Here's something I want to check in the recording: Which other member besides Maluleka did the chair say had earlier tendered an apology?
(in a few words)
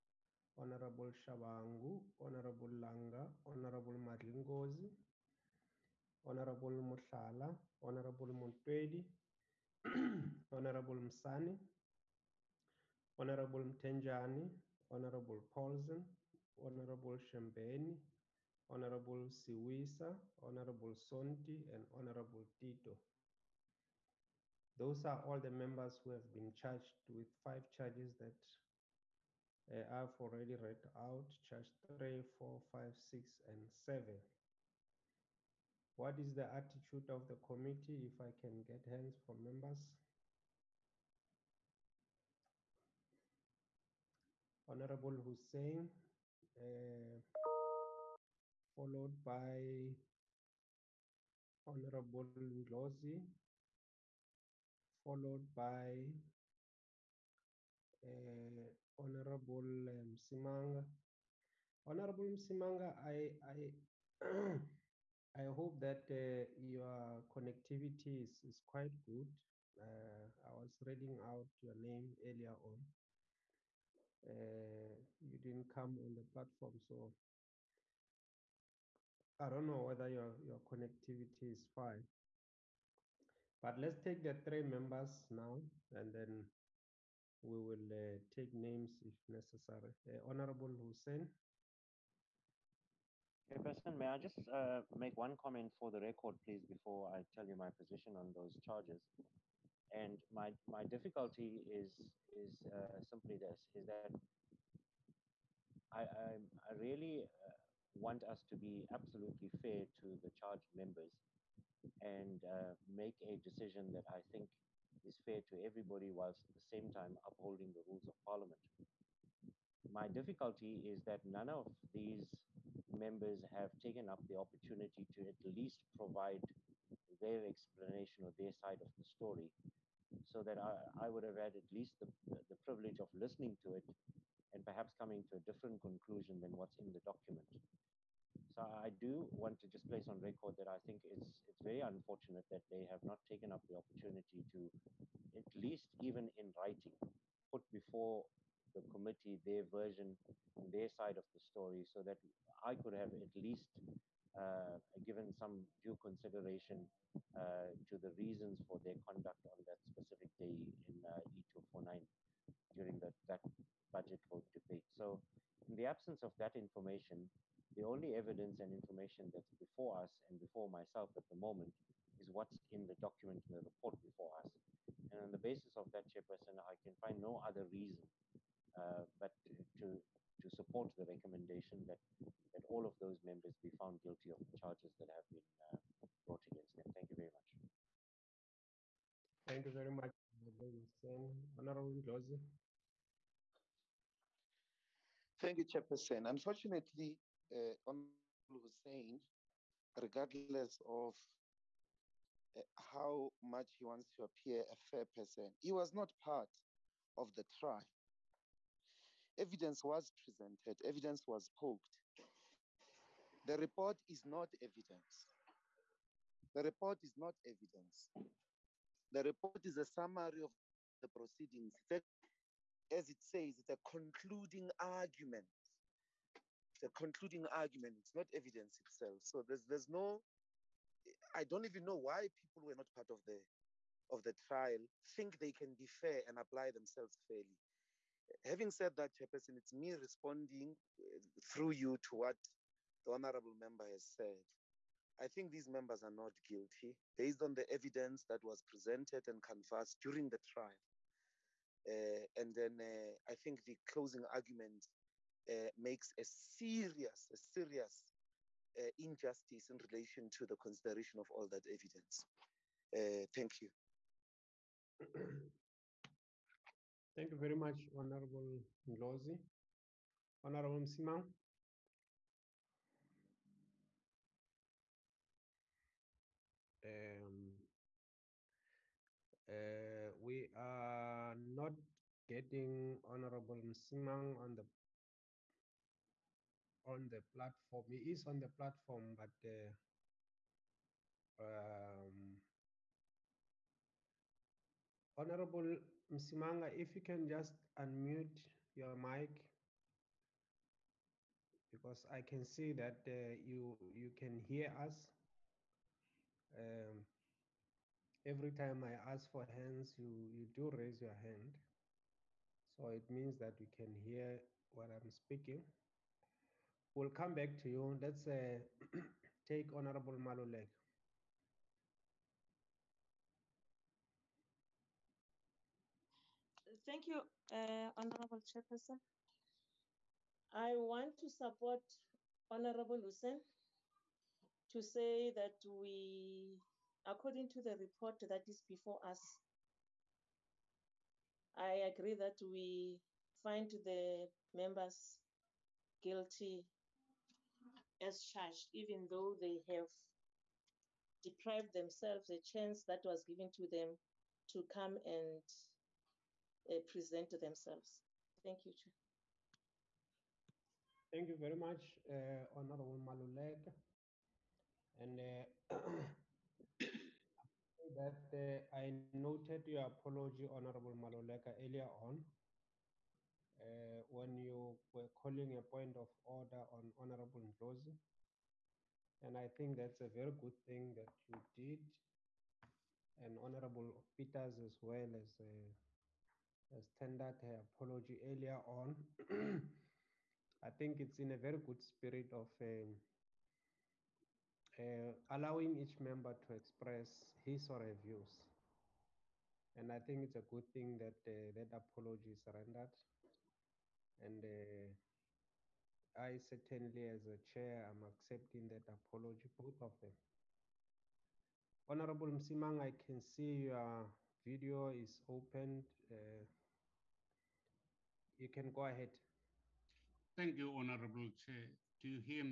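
Peters.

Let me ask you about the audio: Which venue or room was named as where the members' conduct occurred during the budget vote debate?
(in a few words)
E249.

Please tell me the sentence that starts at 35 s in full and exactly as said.
What is the attitude of the committee if I can get hands from members?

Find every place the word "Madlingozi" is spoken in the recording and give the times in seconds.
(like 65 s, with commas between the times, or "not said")
3 s.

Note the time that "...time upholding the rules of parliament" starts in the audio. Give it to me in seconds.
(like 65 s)
116 s.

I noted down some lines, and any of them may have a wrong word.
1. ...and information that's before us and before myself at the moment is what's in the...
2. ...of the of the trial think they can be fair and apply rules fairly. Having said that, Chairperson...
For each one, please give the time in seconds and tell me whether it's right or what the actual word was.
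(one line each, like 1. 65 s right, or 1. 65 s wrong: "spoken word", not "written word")
1. 168 s right
2. 233 s wrong: "themselves", not "rules".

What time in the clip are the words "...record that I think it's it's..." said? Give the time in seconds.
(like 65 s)
140 s.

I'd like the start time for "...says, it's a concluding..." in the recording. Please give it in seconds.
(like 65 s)
223 s.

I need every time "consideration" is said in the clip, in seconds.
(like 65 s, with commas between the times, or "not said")
155 s, 260 s.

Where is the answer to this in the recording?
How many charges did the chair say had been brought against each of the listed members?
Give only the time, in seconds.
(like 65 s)
27 s.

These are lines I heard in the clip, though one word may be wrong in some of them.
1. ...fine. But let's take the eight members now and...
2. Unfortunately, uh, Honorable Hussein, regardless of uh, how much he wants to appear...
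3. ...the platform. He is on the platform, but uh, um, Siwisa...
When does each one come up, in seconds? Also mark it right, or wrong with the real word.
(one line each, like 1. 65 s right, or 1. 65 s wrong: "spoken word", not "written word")
1. 81 s wrong: "three", not "eight"
2. 196 s right
3. 287 s wrong: "Honorable", not "Siwisa".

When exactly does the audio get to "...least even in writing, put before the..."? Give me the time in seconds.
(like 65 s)
145 s.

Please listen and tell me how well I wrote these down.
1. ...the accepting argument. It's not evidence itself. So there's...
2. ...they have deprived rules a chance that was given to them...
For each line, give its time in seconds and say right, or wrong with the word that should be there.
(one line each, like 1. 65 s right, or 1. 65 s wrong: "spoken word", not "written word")
1. 226 s wrong: "concluding", not "accepting"
2. 349 s wrong: "themselves", not "rules".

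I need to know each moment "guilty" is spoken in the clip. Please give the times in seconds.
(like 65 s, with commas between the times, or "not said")
184 s, 246 s, 345 s.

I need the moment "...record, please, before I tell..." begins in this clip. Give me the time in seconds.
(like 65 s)
95 s.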